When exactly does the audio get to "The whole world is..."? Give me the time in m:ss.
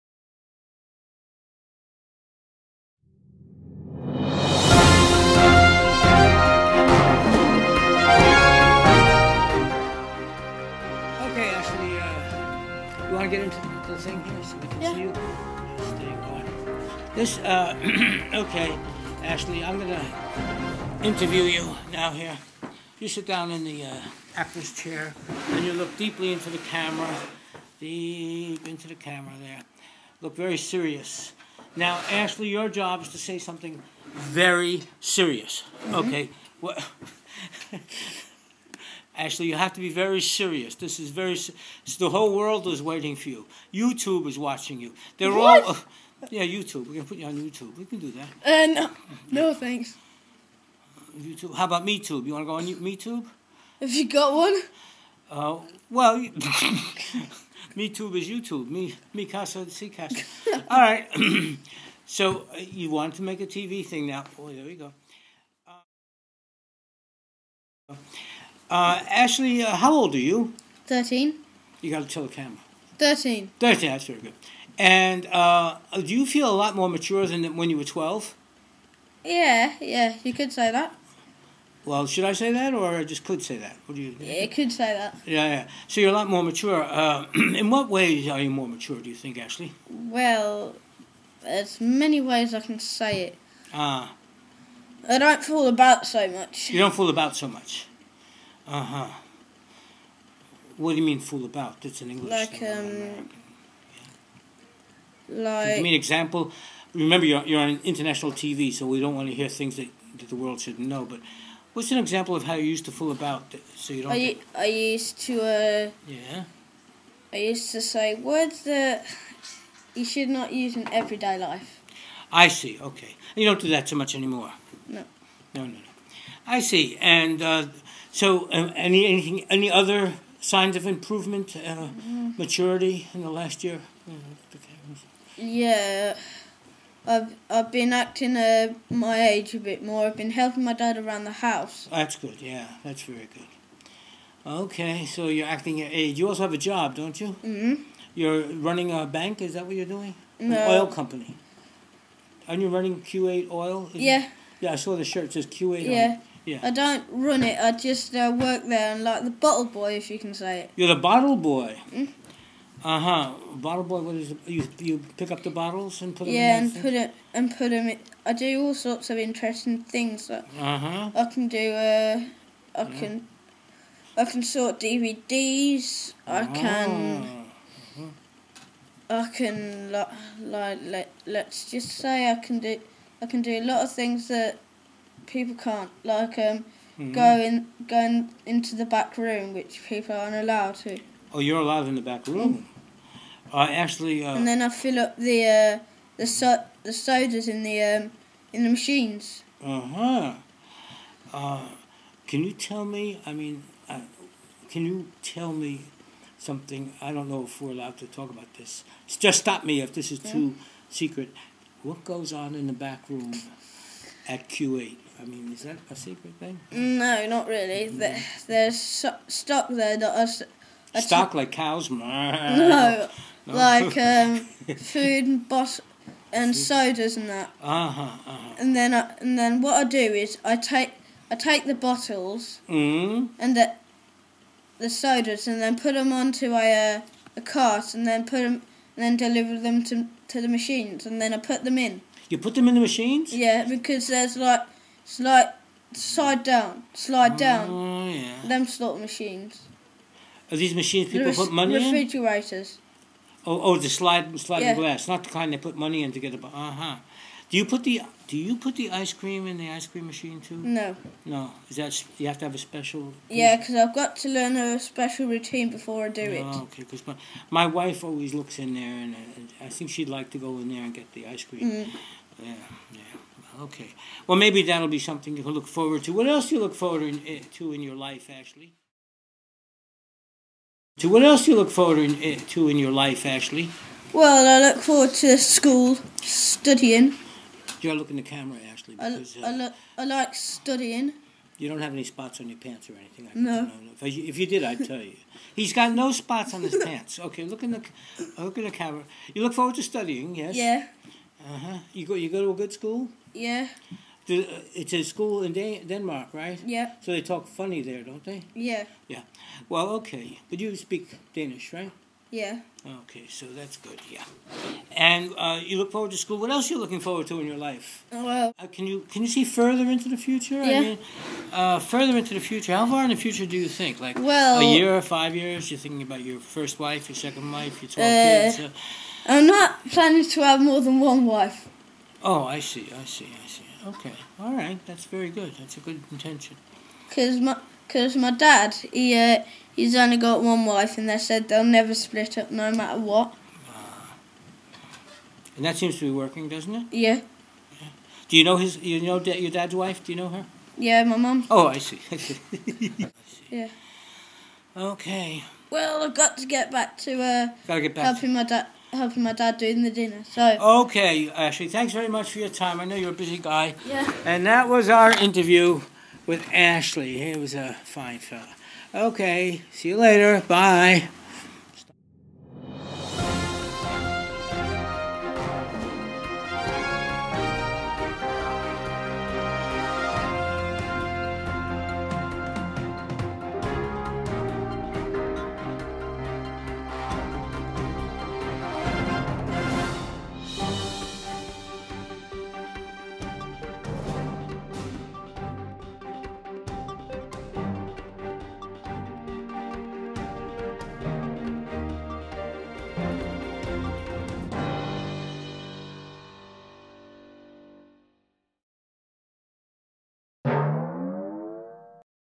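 0:41.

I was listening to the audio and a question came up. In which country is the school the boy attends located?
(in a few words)
Denmark.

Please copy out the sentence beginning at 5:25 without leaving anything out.
You're thinking about your first wife, your second wife, your twelve uh, kids.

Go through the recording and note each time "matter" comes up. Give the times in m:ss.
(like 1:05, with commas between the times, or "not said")
5:42.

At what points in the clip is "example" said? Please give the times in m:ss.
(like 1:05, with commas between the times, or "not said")
1:45, 1:51.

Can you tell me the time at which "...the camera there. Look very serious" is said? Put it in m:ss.
0:28.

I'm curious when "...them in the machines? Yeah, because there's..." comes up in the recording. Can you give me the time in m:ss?
4:02.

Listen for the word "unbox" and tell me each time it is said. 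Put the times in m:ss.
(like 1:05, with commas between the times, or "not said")
not said.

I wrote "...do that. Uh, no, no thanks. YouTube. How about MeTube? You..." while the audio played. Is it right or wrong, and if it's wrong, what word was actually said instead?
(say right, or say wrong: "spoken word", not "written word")
right.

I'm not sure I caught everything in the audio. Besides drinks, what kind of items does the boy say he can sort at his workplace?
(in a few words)
DVDs.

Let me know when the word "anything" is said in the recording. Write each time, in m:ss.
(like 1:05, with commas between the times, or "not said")
2:09, 4:52.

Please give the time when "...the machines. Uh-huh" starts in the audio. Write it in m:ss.
3:18.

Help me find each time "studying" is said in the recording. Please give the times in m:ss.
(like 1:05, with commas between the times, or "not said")
4:46, 4:50, 4:59.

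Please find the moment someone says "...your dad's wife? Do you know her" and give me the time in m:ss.
5:49.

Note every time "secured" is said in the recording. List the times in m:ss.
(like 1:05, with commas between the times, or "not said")
not said.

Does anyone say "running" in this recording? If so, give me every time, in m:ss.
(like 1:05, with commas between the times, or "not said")
2:28, 2:32.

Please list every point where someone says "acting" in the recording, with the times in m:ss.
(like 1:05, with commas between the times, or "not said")
2:17, 2:25.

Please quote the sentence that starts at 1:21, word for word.
Well, should I say that, or I just could say that?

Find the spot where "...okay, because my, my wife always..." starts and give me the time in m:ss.
4:26.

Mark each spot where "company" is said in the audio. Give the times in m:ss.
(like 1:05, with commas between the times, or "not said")
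2:30.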